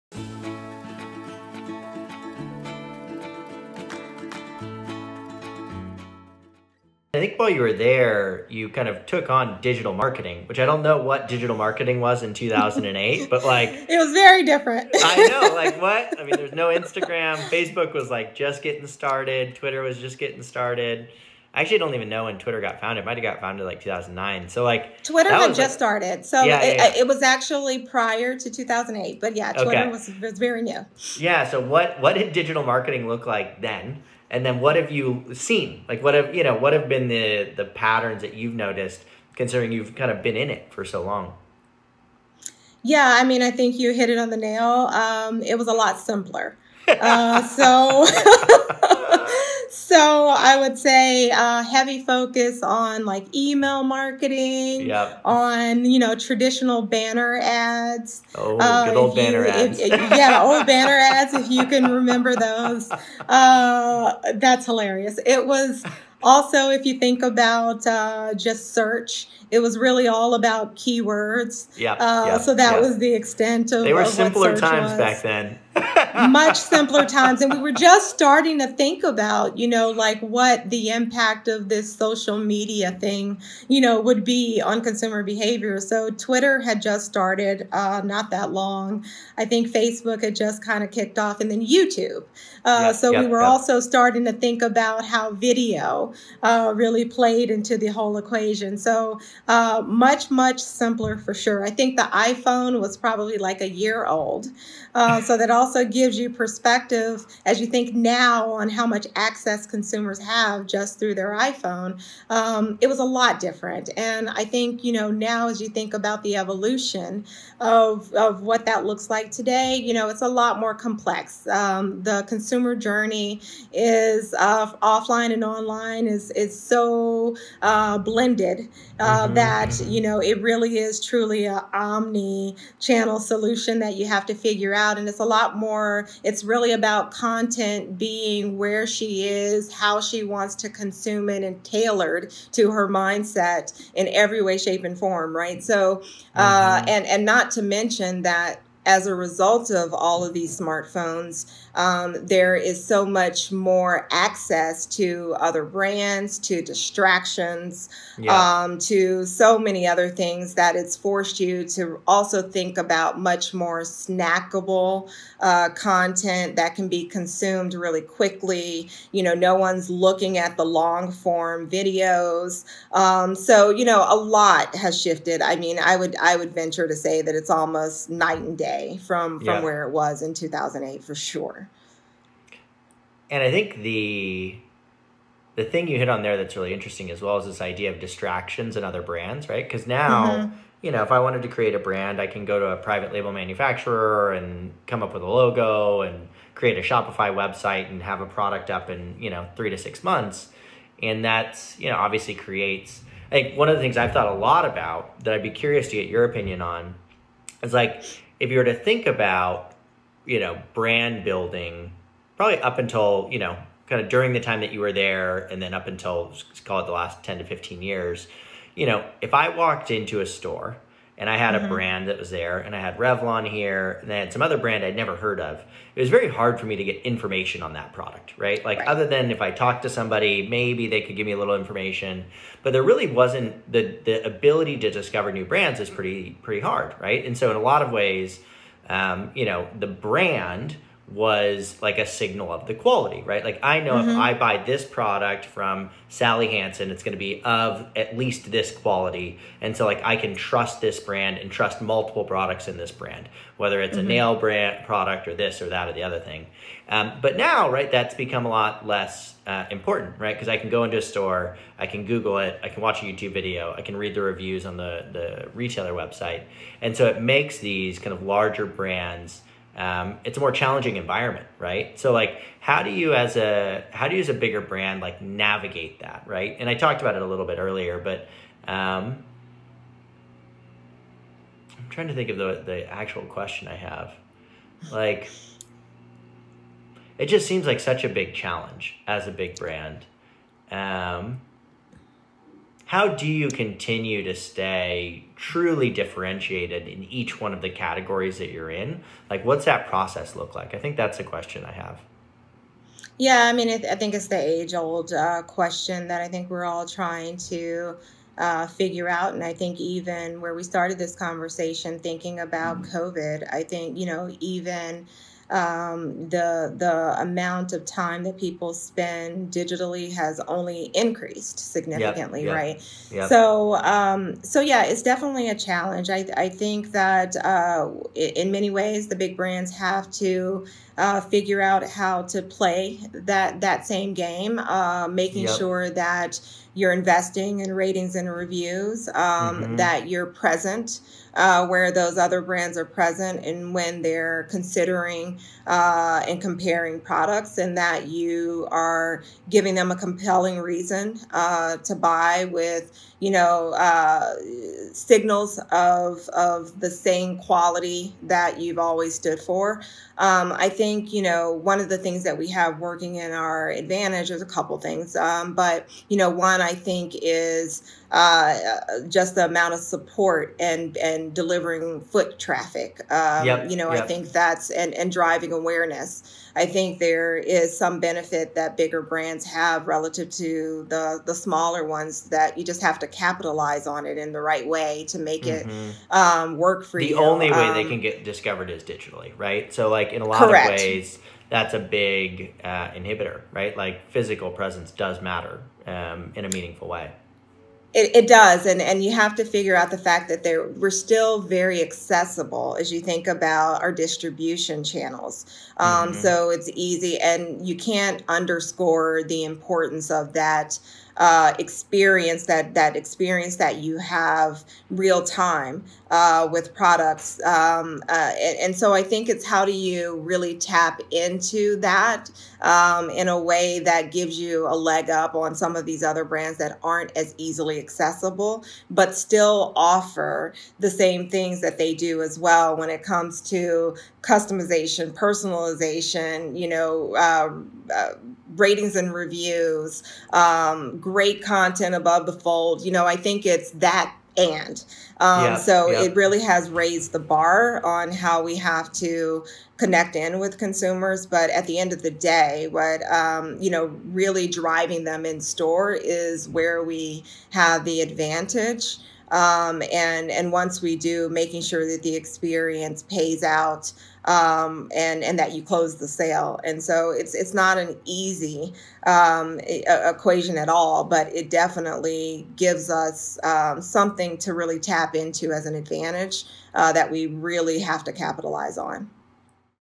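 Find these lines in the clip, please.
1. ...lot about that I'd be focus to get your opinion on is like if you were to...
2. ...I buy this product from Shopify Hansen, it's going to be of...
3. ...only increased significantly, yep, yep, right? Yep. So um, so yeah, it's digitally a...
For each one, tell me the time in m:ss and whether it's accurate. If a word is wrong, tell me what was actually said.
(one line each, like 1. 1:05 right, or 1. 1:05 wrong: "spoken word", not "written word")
1. 3:24 wrong: "curious", not "focus"
2. 4:04 wrong: "Sally", not "Shopify"
3. 5:20 wrong: "definitely", not "digitally".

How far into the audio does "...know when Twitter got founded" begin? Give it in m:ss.
0:22.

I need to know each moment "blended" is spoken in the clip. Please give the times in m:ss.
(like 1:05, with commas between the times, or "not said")
2:07.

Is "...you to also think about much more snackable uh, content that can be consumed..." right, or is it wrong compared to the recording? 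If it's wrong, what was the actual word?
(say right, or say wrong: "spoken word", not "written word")
right.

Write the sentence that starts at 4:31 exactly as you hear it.
So like, how do you as a how do you as a bigger brand like navigate that, right?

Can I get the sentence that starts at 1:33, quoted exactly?
also starting to think about how video uh, really played into the whole equation.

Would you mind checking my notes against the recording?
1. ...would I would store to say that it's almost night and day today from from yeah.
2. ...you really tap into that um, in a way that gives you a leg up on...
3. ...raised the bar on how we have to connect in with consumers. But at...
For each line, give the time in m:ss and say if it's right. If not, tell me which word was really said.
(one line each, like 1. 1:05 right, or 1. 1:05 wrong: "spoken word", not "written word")
1. 2:55 wrong: "venture", not "store"
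2. 6:59 right
3. 7:26 right.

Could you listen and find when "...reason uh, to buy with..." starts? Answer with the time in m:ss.
5:50.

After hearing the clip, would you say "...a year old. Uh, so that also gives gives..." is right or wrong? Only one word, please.
right.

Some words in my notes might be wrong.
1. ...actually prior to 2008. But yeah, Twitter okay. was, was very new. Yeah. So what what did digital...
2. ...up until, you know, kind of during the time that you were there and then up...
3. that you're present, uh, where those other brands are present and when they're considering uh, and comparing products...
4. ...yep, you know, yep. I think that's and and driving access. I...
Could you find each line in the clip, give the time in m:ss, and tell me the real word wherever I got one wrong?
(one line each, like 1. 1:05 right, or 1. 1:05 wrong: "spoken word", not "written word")
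1. 0:27 right
2. 3:32 right
3. 5:39 right
4. 6:13 wrong: "awareness", not "access".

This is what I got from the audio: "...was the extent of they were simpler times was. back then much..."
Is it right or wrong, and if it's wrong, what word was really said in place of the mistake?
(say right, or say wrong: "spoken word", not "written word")
right.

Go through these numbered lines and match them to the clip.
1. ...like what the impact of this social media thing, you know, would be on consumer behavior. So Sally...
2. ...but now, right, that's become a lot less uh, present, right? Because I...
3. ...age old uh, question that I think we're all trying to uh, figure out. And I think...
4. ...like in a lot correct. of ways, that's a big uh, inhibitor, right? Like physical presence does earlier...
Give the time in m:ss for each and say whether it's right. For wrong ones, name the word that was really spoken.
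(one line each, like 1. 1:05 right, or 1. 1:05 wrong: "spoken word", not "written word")
1. 1:19 wrong: "Twitter", not "Sally"
2. 4:17 wrong: "important", not "present"
3. 5:04 right
4. 6:29 wrong: "matter", not "earlier".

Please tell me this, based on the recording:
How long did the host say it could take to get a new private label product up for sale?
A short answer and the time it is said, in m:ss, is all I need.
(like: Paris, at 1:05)
3 to 6 months, at 3:19.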